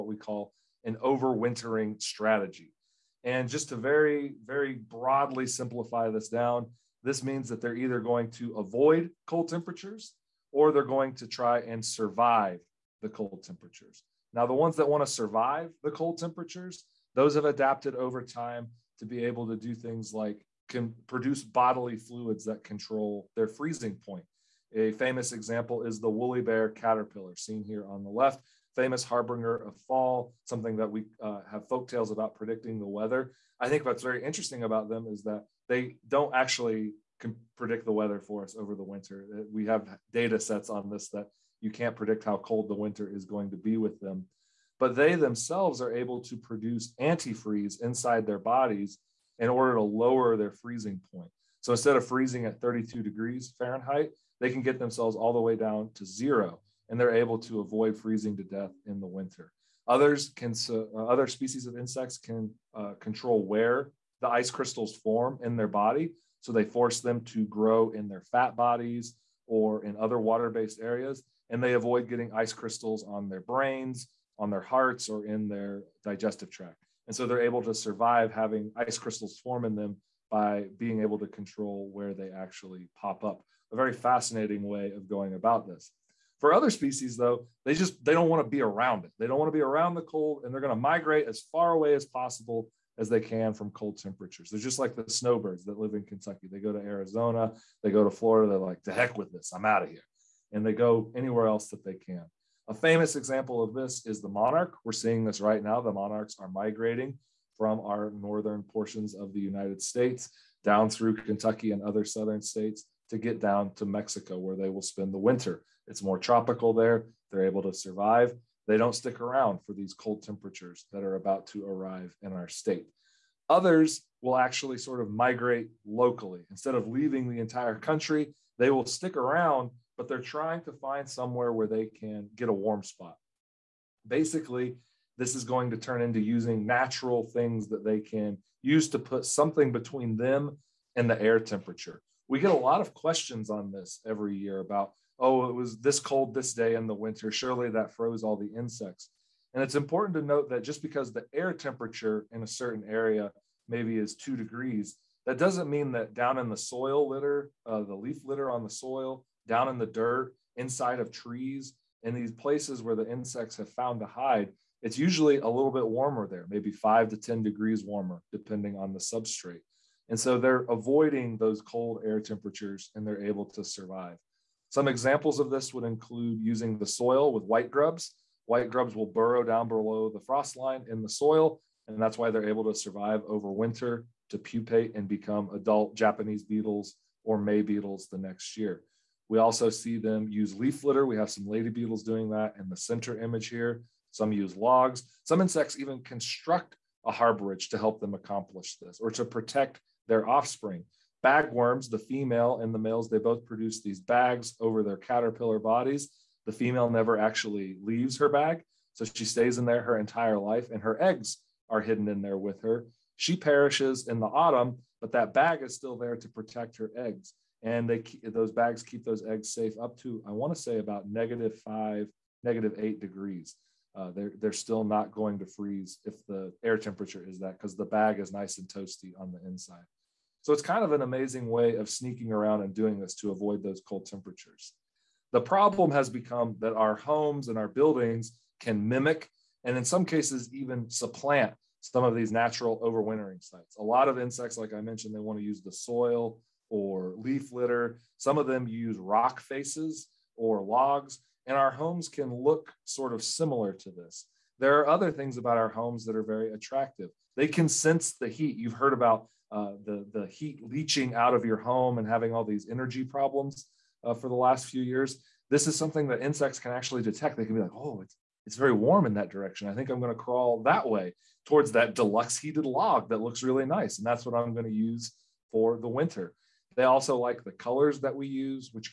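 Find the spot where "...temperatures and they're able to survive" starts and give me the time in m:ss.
2:52.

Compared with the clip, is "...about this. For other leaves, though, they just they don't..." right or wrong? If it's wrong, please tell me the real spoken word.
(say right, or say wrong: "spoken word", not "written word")
wrong: "species", not "leaves".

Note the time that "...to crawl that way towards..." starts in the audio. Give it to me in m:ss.
4:30.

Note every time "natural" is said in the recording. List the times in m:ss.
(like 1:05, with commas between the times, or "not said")
2:16, 4:02.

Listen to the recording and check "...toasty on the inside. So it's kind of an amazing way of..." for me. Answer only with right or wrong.
right.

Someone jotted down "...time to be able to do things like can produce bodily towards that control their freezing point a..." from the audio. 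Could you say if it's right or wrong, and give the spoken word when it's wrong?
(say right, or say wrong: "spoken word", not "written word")
wrong: "fluids", not "towards".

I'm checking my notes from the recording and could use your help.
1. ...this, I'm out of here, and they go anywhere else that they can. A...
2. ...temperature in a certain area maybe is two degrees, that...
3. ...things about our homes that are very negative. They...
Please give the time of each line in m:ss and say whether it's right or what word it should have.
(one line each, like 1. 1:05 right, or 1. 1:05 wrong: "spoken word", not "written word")
1. 1:39 right
2. 2:31 right
3. 4:15 wrong: "attractive", not "negative".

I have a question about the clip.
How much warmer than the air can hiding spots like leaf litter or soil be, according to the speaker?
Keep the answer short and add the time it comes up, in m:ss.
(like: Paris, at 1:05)
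5 to 10 degrees, at 2:46.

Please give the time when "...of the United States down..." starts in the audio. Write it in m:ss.
1:49.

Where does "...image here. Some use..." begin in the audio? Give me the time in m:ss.
3:13.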